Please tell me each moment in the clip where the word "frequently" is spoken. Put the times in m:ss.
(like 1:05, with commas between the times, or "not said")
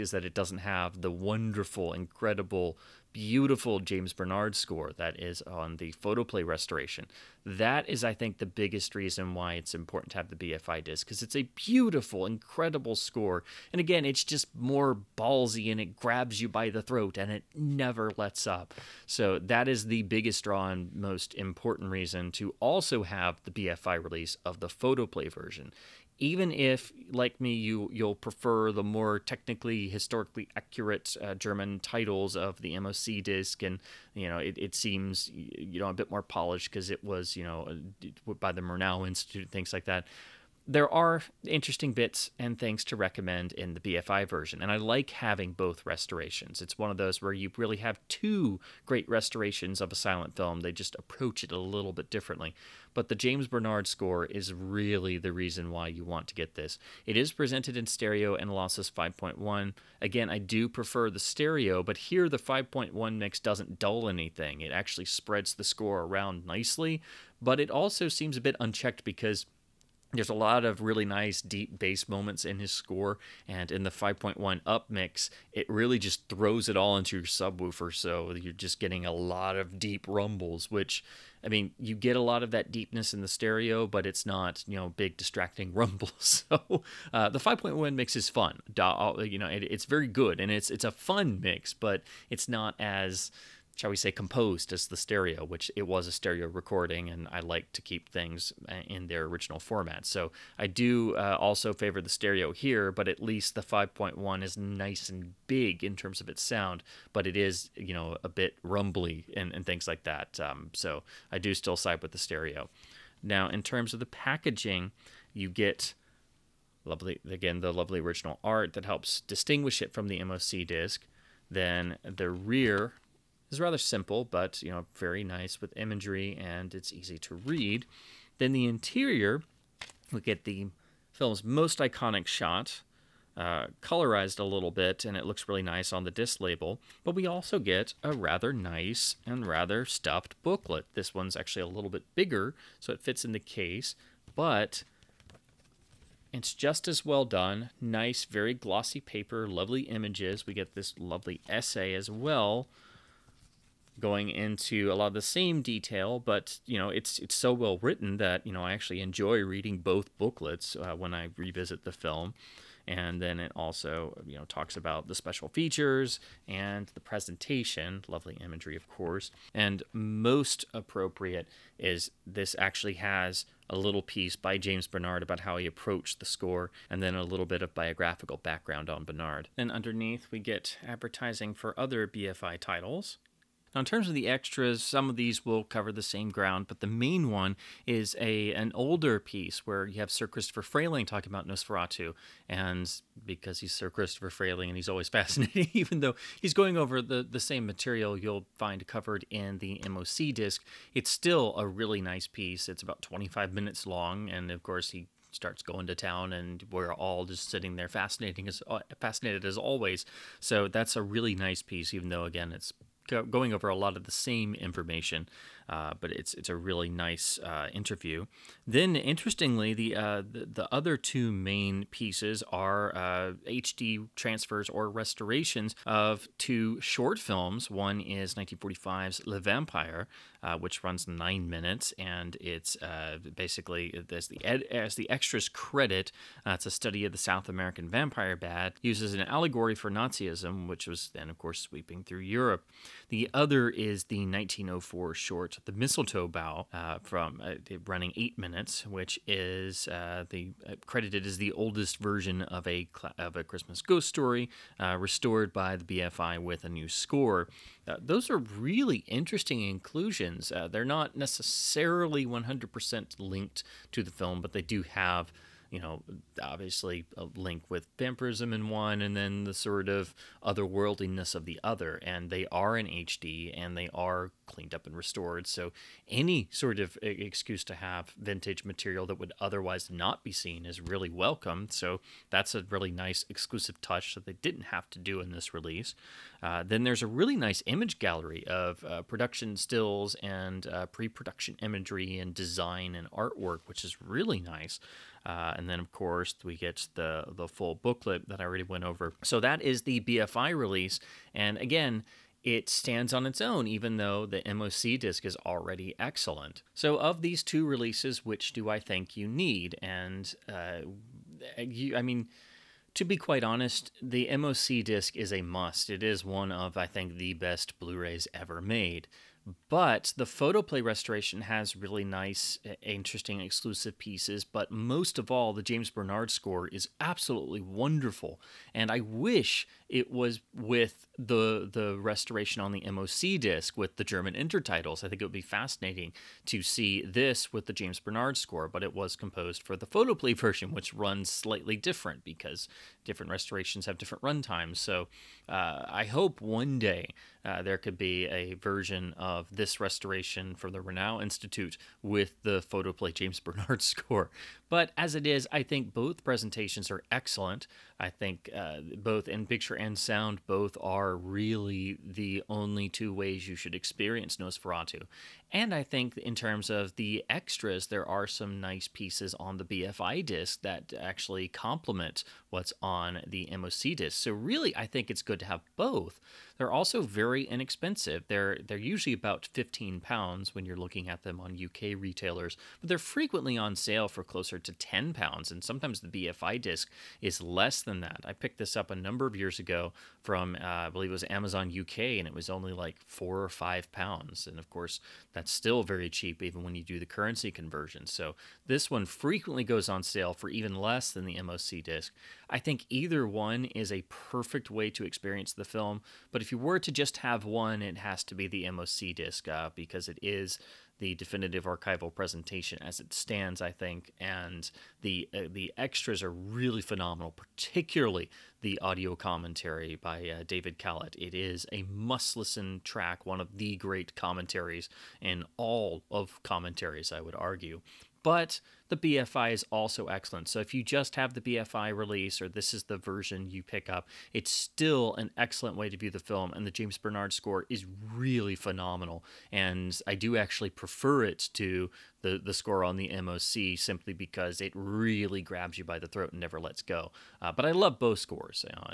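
6:22, 6:39.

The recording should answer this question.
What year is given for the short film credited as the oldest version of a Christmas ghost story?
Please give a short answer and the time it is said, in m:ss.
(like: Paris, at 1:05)
1904, at 4:04.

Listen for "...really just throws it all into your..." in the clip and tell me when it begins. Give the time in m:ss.
1:15.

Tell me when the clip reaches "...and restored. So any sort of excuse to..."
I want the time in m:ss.
4:34.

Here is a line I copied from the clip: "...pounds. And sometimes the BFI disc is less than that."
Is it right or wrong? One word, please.
right.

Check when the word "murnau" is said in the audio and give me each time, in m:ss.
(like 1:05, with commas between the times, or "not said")
0:38, 5:50.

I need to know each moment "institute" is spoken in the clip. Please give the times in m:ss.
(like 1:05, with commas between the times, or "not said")
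0:39, 5:51.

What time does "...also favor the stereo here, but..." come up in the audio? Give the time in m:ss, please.
1:41.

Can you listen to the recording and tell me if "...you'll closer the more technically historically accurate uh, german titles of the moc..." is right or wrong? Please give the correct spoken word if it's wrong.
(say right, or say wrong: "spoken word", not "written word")
wrong: "prefer", not "closer".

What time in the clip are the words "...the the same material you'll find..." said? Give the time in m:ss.
3:17.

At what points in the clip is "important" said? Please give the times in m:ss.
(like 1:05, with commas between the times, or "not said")
0:09, 0:21.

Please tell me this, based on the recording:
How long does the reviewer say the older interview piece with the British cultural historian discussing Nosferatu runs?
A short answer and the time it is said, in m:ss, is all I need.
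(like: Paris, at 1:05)
25 minutes, at 3:23.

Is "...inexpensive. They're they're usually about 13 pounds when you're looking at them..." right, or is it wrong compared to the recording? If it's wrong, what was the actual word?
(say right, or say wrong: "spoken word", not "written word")
wrong: "15", not "13".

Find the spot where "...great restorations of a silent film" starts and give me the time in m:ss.
0:48.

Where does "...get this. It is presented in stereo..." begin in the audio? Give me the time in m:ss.
0:56.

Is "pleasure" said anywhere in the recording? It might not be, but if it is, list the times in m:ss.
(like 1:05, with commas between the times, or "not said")
not said.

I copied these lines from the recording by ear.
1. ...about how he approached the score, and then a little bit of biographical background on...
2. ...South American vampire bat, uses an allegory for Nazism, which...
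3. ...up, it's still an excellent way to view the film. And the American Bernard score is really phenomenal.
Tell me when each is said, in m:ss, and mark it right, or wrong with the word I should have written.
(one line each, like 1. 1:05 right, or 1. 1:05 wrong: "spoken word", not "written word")
1. 2:55 right
2. 3:57 right
3. 7:13 wrong: "James", not "American".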